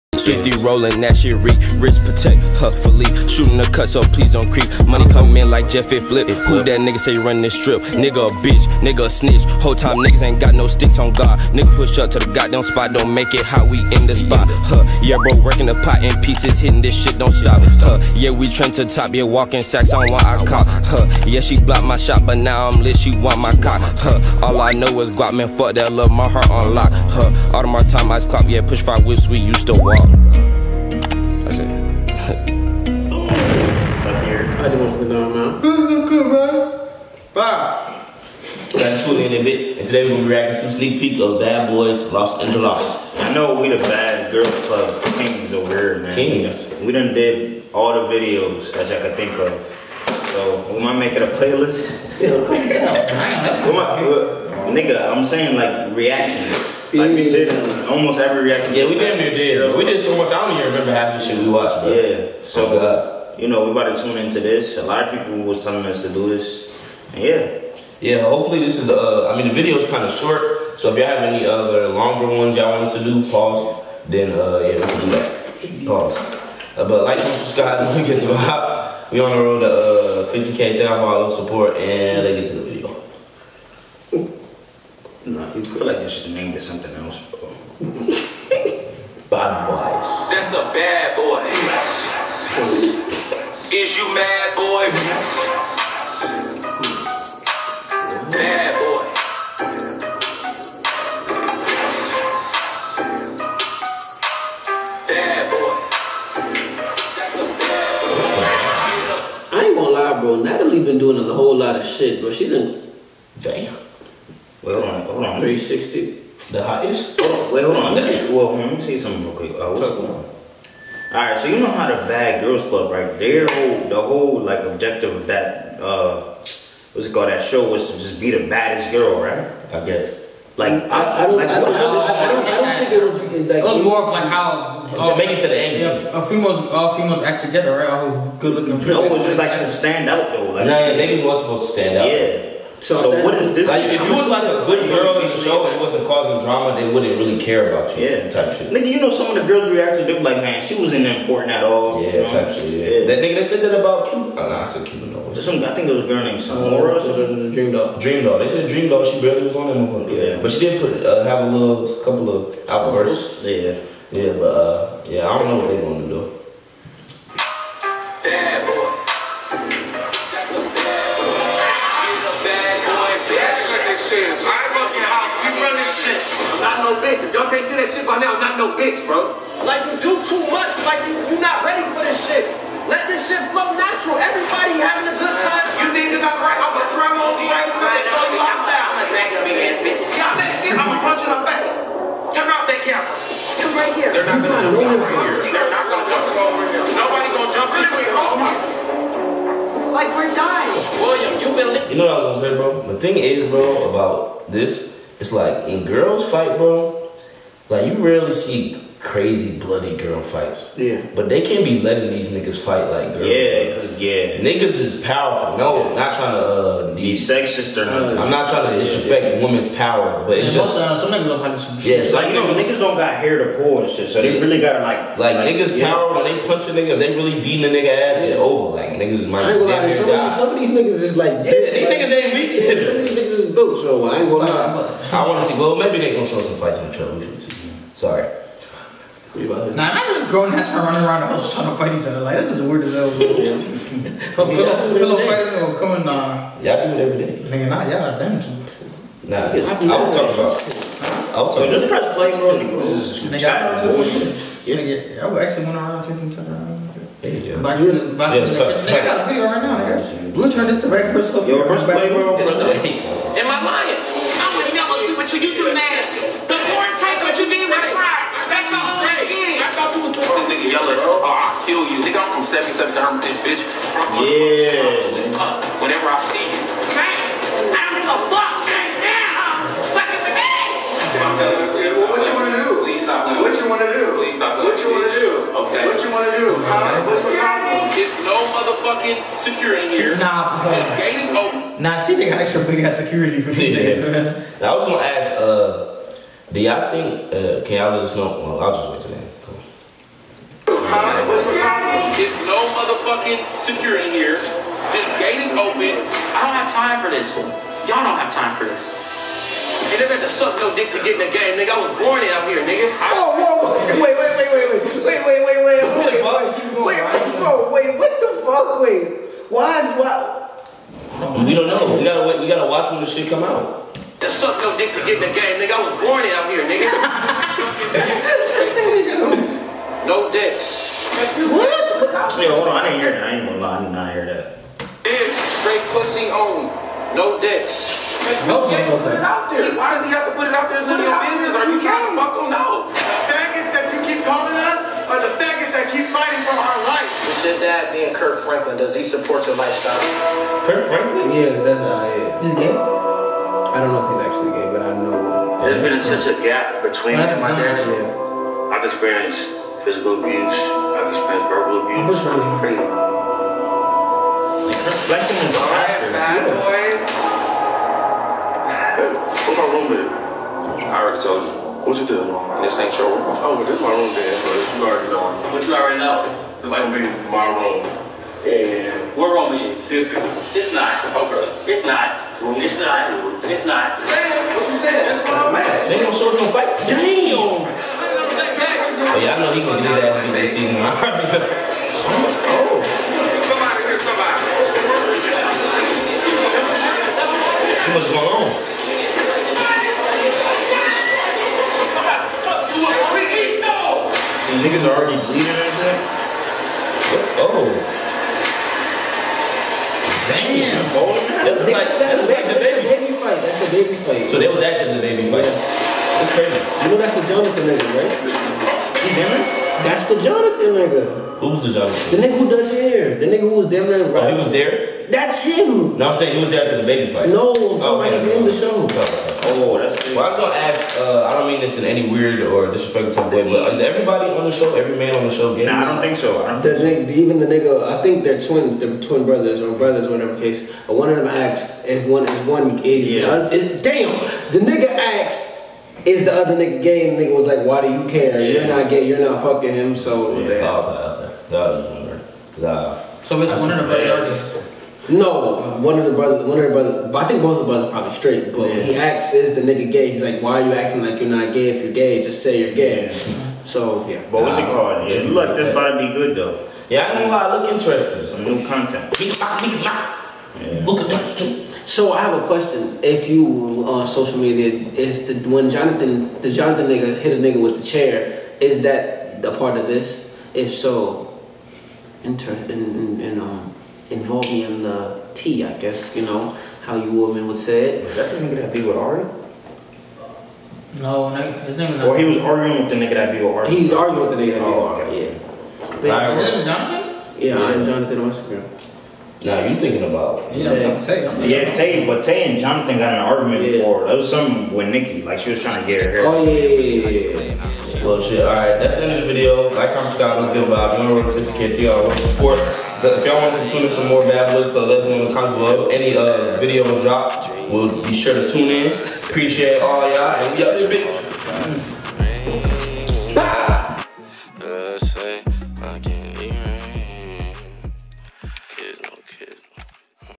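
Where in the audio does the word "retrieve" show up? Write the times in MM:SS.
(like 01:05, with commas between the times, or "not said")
not said.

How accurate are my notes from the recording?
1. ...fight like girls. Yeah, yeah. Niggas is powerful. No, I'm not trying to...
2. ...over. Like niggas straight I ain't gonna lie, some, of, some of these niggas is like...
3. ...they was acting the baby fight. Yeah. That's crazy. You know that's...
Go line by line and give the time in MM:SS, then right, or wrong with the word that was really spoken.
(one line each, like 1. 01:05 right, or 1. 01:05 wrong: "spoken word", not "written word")
1. 03:32 right
2. 03:48 wrong: "might", not "straight"
3. 06:54 right.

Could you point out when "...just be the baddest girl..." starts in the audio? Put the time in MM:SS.
02:07.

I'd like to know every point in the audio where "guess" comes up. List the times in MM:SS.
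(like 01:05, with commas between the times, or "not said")
02:09, 08:05.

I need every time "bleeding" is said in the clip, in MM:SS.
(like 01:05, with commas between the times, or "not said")
06:45.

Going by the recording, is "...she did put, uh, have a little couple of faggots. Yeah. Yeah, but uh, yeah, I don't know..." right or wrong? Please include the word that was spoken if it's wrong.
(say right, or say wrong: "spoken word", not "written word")
wrong: "outbursts", not "faggots".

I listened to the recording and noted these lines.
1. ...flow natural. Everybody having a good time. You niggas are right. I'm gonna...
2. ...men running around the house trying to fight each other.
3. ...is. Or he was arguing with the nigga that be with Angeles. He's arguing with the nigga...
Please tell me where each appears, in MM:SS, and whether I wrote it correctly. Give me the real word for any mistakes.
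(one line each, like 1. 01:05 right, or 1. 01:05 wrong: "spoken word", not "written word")
1. 03:03 right
2. 04:00 right
3. 08:11 wrong: "Ari", not "Angeles".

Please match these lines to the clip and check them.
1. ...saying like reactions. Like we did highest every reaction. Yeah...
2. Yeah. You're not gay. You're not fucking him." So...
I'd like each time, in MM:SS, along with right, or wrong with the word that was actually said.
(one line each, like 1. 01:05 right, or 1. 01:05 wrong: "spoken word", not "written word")
1. 00:55 wrong: "almost", not "highest"
2. 07:28 right.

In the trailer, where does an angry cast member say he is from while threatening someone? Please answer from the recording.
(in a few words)
77 to Hermitage.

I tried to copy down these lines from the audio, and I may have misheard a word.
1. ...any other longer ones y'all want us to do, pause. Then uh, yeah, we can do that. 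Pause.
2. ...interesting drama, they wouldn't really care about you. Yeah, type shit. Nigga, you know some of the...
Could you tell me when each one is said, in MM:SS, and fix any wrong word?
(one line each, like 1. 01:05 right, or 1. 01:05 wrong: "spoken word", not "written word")
1. 01:11 right
2. 02:26 wrong: "causing", not "interesting".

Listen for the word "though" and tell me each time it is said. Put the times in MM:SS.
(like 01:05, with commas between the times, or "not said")
02:20, 07:46.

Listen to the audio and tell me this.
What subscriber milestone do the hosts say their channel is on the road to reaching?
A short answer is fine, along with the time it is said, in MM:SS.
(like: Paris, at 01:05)
50k, at 01:20.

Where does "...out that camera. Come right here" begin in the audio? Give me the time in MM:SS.
03:12.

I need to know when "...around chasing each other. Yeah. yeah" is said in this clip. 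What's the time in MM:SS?
04:15.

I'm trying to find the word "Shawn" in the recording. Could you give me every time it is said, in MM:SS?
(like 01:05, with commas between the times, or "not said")
not said.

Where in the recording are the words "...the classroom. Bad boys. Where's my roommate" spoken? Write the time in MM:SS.
06:05.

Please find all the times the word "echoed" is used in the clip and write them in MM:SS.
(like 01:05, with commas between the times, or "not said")
not said.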